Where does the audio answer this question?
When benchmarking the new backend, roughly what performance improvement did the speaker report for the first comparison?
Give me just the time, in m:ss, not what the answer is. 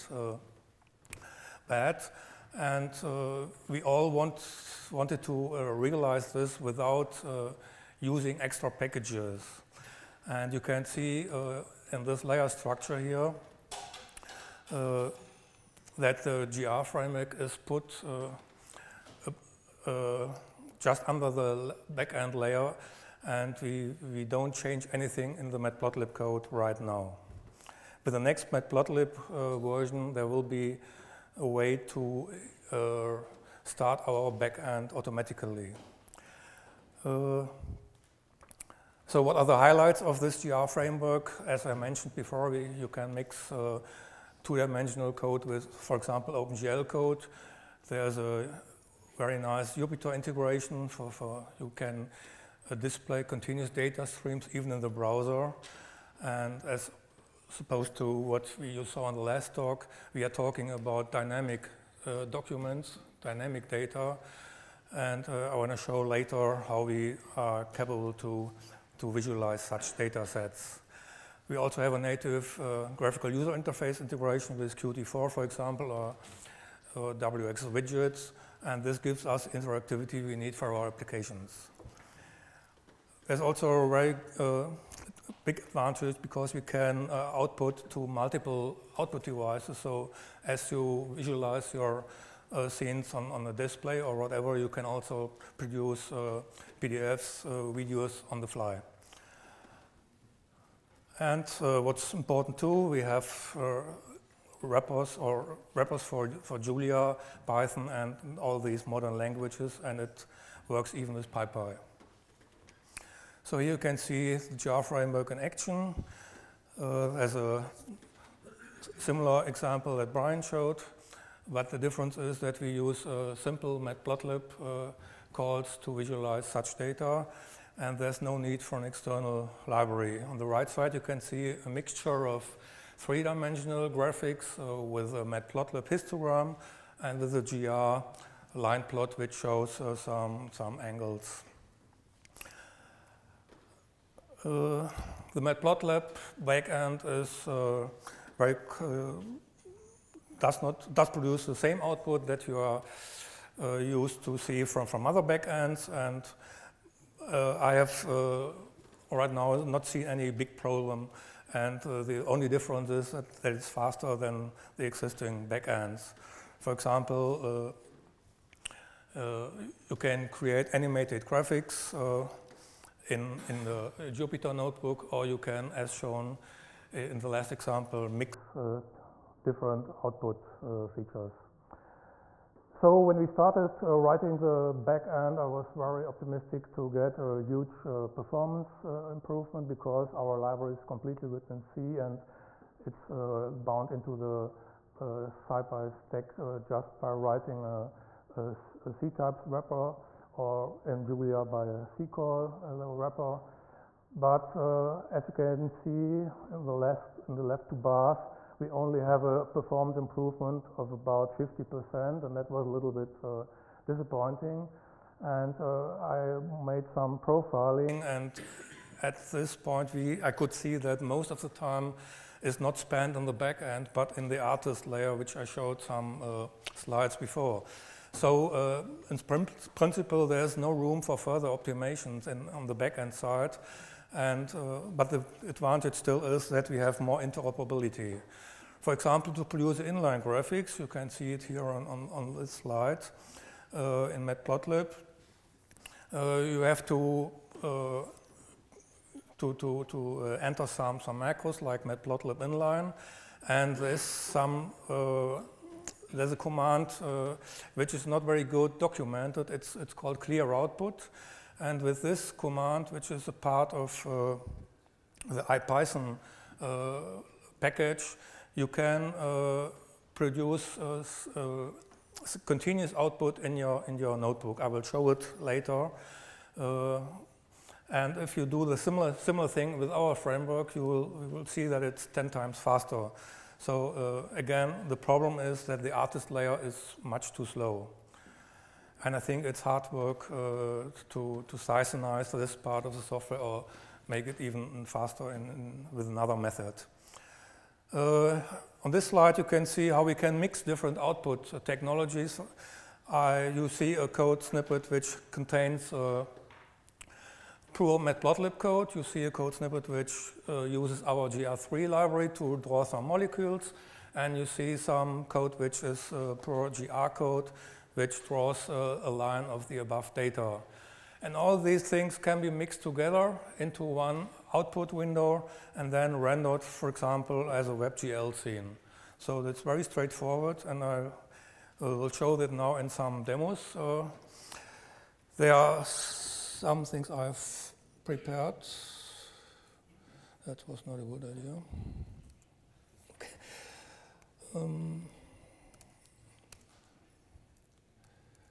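3:31.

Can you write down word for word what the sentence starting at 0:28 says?
With the next matplotlib uh, version, there will be a way to uh, start our backend automatically.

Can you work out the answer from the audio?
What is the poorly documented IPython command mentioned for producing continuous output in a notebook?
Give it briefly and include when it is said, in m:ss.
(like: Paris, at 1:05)
clear output, at 4:20.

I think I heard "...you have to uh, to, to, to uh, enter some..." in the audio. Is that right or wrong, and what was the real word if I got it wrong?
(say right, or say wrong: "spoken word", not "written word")
right.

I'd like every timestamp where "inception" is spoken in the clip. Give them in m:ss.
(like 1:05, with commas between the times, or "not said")
not said.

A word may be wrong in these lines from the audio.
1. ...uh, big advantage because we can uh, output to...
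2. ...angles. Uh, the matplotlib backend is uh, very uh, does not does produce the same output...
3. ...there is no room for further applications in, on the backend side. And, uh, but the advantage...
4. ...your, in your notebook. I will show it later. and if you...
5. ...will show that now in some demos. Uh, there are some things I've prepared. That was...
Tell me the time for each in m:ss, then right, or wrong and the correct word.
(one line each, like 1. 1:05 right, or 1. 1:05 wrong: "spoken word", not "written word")
1. 1:24 right
2. 2:20 right
3. 3:50 wrong: "optimizations", not "applications"
4. 4:33 right
5. 5:31 right.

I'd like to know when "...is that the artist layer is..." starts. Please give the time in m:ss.
4:45.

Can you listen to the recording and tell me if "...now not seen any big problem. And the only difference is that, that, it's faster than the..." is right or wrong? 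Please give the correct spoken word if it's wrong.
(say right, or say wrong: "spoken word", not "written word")
right.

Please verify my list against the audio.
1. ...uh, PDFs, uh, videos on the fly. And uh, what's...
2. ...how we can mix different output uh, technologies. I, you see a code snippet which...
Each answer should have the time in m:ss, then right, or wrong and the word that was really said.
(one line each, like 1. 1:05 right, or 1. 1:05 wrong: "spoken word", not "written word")
1. 1:36 right
2. 4:59 right.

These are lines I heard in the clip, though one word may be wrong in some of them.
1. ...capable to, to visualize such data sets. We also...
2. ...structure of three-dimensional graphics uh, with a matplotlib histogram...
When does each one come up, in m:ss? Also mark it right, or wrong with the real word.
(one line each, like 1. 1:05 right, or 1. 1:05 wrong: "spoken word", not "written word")
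1. 1:07 right
2. 2:11 wrong: "mixture", not "structure".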